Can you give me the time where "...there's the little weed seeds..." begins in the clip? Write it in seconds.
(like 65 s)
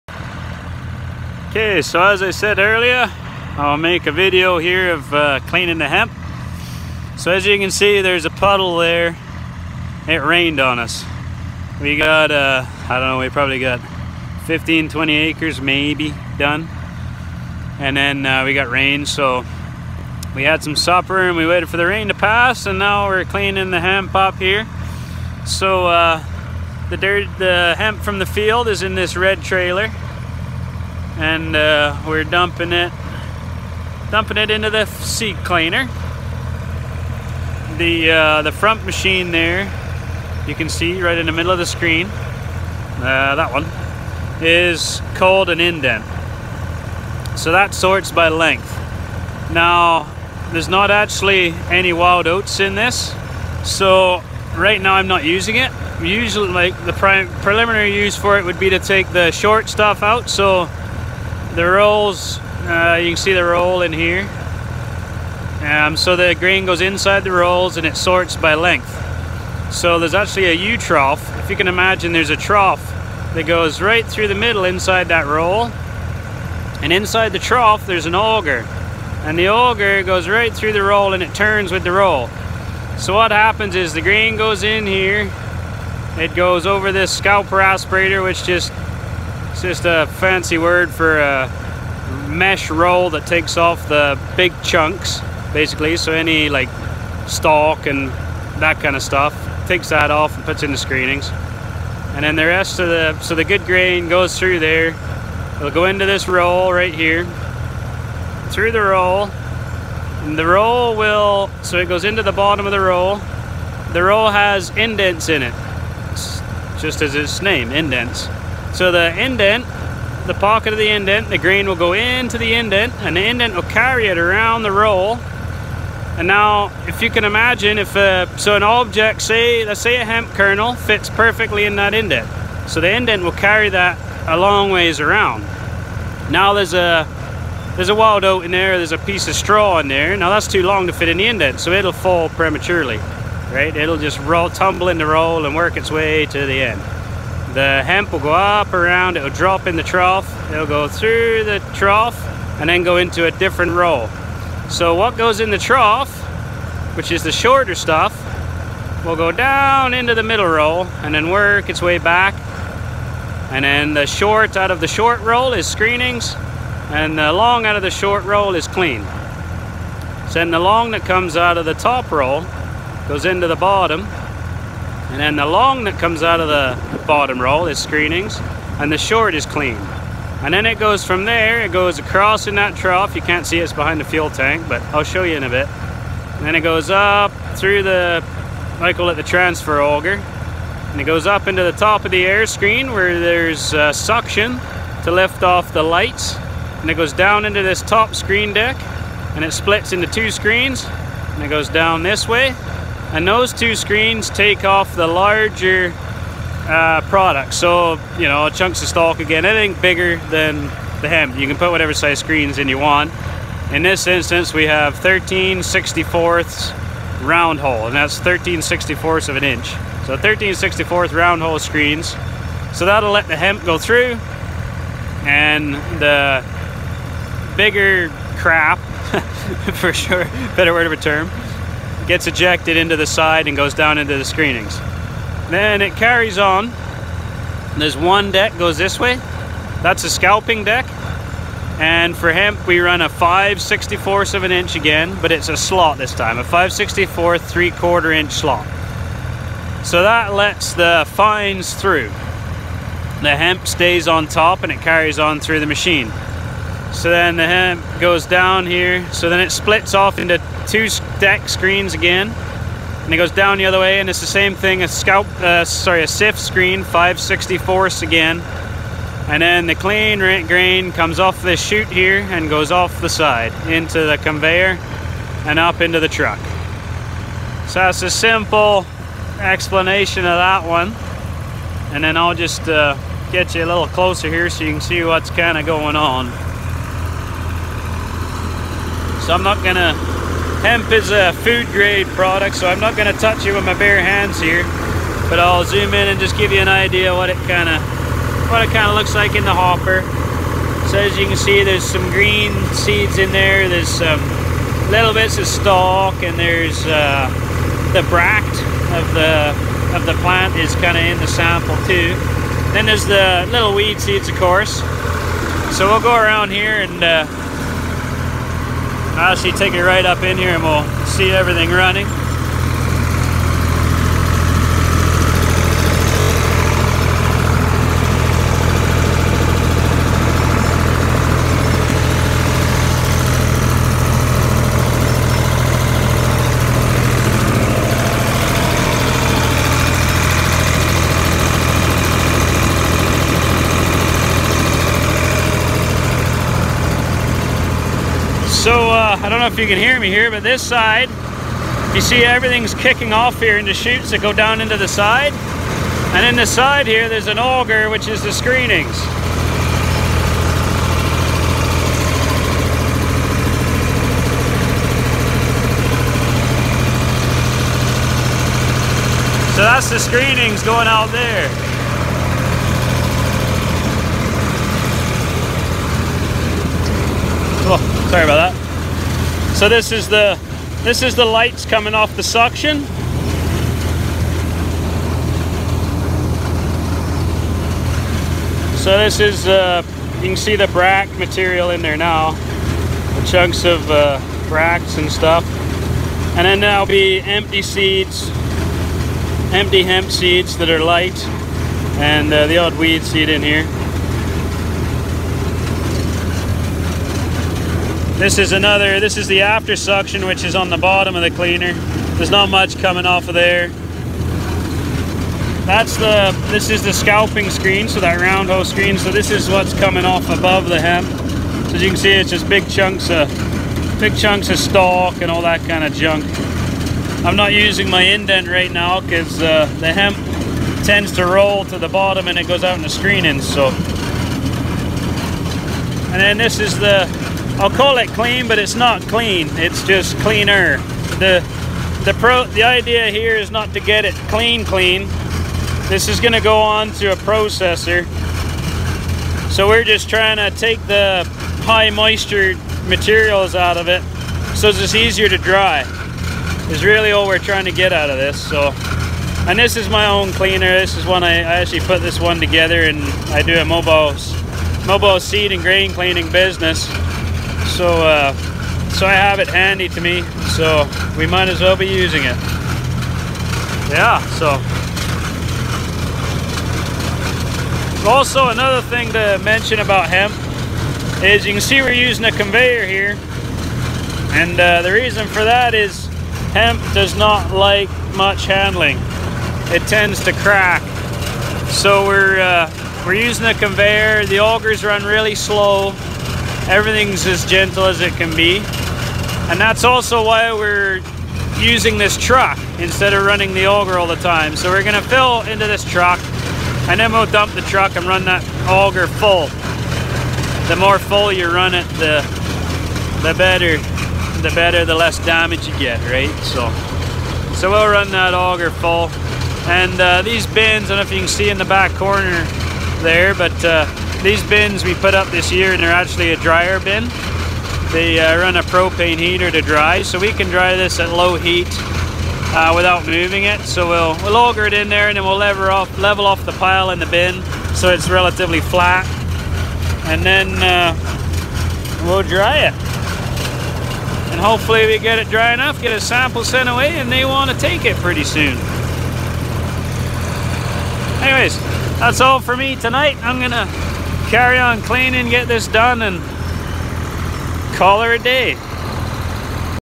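312 s.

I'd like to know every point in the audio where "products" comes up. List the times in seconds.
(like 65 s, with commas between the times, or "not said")
207 s, 292 s.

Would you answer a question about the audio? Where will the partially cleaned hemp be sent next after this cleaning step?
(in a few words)
A processor.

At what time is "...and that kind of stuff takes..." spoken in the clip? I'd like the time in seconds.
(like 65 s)
97 s.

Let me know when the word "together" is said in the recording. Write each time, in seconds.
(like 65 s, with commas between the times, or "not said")
462 s.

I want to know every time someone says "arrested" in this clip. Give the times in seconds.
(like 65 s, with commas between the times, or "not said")
not said.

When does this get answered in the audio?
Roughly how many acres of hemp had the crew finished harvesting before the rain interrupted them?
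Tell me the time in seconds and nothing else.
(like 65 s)
14 s.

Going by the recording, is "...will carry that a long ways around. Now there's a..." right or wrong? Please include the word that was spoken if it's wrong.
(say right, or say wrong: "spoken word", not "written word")
right.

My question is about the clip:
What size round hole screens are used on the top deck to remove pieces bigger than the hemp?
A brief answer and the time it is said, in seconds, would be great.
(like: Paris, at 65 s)
13/64 inch, at 214 s.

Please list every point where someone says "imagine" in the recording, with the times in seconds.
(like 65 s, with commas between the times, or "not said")
71 s, 127 s.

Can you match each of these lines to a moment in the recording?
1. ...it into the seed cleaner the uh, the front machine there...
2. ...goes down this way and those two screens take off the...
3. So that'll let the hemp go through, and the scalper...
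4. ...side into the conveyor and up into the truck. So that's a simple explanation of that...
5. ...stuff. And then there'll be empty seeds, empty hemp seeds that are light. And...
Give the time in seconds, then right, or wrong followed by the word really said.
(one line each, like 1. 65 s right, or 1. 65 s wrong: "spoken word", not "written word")
1. 34 s right
2. 201 s right
3. 222 s wrong: "bigger", not "scalper"
4. 273 s right
5. 395 s right.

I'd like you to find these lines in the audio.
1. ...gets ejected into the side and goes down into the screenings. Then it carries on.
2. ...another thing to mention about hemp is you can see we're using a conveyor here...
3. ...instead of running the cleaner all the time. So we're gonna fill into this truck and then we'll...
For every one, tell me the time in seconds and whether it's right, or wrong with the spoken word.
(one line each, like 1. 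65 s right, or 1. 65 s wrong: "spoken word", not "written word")
1. 232 s right
2. 478 s right
3. 502 s wrong: "auger", not "cleaner".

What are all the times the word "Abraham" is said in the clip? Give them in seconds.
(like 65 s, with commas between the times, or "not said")
not said.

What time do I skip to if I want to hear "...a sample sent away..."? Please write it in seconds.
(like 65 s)
545 s.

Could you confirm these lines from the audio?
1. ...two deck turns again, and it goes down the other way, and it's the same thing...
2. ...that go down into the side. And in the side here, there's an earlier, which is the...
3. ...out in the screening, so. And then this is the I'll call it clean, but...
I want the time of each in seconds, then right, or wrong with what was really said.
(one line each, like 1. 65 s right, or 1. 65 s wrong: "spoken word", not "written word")
1. 260 s wrong: "screens", not "turns"
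2. 354 s wrong: "auger", not "earlier"
3. 432 s right.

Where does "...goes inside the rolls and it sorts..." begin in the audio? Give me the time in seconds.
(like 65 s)
66 s.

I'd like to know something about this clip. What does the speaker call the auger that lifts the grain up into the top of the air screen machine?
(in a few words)
Transfer auger.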